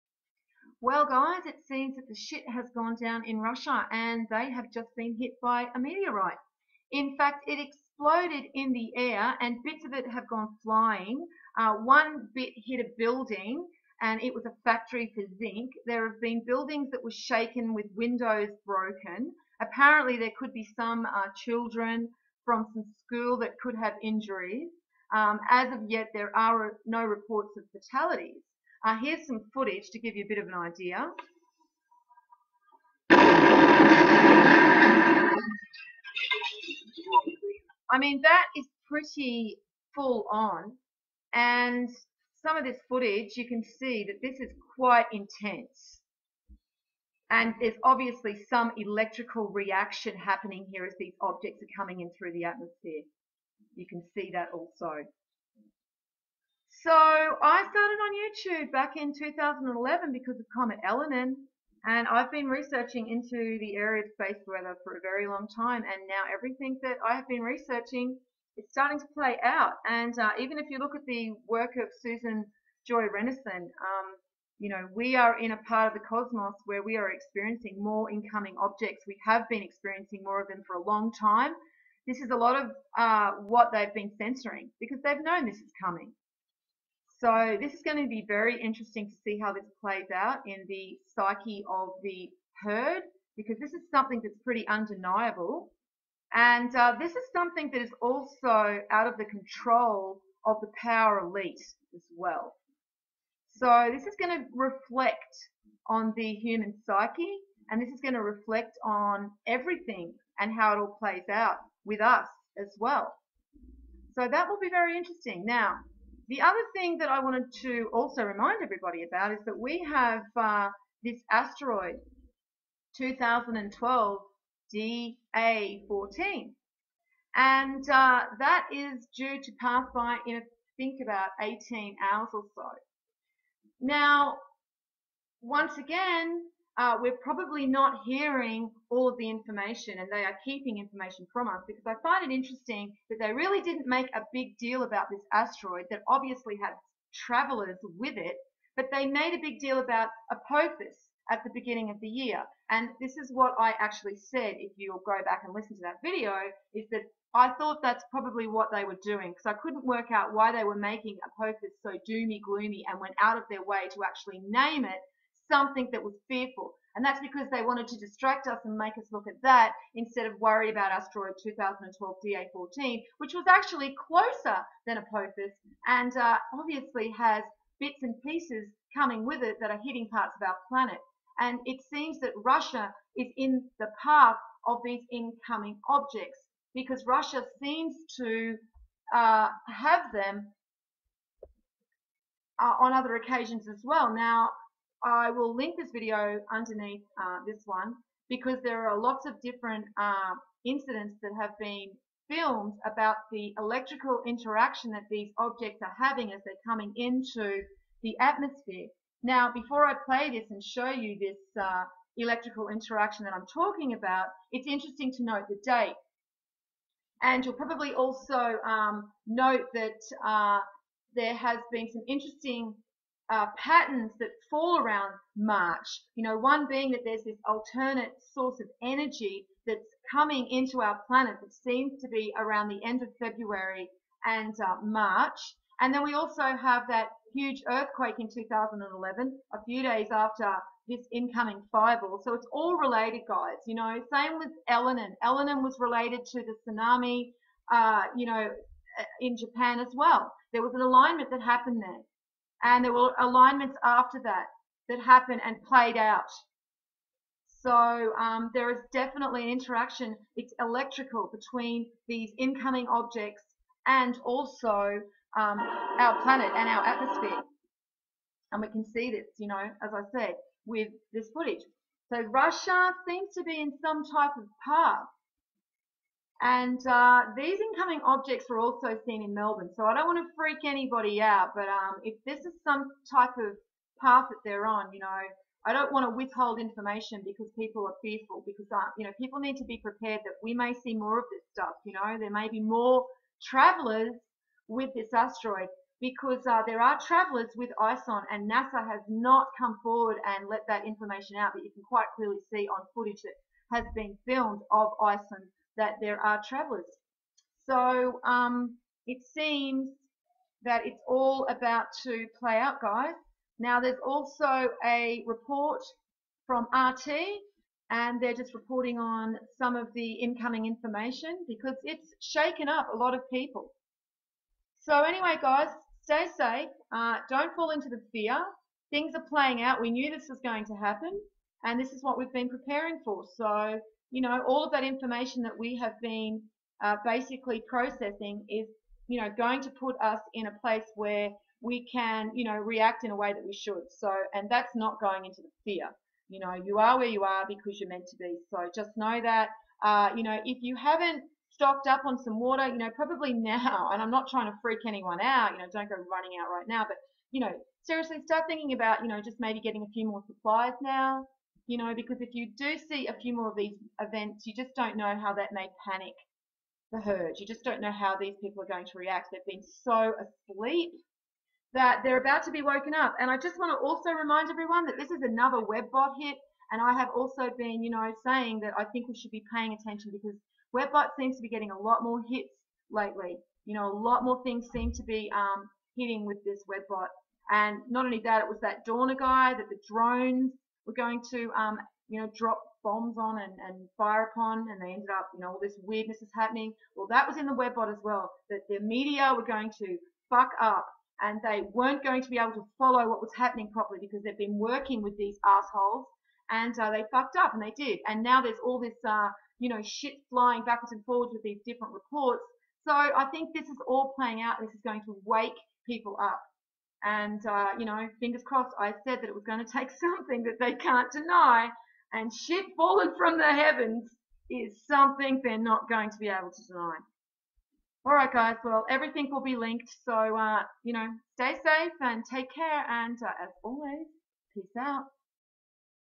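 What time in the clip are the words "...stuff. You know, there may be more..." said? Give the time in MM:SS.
04:51.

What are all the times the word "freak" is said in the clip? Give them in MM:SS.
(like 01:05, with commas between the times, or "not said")
04:40, 05:54.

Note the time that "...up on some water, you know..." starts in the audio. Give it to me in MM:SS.
05:51.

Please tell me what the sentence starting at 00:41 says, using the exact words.
And some of this footage, you can see that this is quite intense.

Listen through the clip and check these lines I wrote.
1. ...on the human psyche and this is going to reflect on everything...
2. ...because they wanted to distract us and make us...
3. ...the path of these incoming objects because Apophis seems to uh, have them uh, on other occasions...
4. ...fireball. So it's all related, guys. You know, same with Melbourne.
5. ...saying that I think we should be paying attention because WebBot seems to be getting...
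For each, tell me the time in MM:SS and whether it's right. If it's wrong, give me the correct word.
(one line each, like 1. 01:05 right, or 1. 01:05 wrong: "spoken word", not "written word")
1. 01:45 right
2. 02:47 right
3. 03:03 wrong: "Russia", not "Apophis"
4. 04:01 wrong: "Elenin", not "Melbourne"
5. 06:18 right.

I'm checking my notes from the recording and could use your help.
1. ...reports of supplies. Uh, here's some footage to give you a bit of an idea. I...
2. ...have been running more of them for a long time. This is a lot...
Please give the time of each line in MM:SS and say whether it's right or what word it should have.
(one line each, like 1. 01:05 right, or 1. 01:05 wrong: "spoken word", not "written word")
1. 00:27 wrong: "fatalities", not "supplies"
2. 01:19 wrong: "experiencing", not "running".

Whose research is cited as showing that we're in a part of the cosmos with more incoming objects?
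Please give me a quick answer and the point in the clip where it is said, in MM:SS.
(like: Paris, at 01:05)
Susan Joy Rennison, at 01:12.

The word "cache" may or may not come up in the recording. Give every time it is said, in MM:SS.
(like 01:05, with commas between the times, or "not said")
not said.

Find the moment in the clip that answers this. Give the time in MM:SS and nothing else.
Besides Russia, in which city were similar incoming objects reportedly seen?
04:39.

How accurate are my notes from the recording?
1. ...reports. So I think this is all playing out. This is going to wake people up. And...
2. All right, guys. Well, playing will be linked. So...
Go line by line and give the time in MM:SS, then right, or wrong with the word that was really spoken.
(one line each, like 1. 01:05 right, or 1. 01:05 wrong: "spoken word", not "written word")
1. 06:51 right
2. 07:08 wrong: "everything", not "playing".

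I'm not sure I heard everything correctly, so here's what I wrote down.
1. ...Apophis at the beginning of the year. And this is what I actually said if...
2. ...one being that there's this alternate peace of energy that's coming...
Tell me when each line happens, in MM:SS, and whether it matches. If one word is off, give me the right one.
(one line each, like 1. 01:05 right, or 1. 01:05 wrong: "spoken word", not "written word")
1. 02:30 right
2. 03:46 wrong: "source", not "peace".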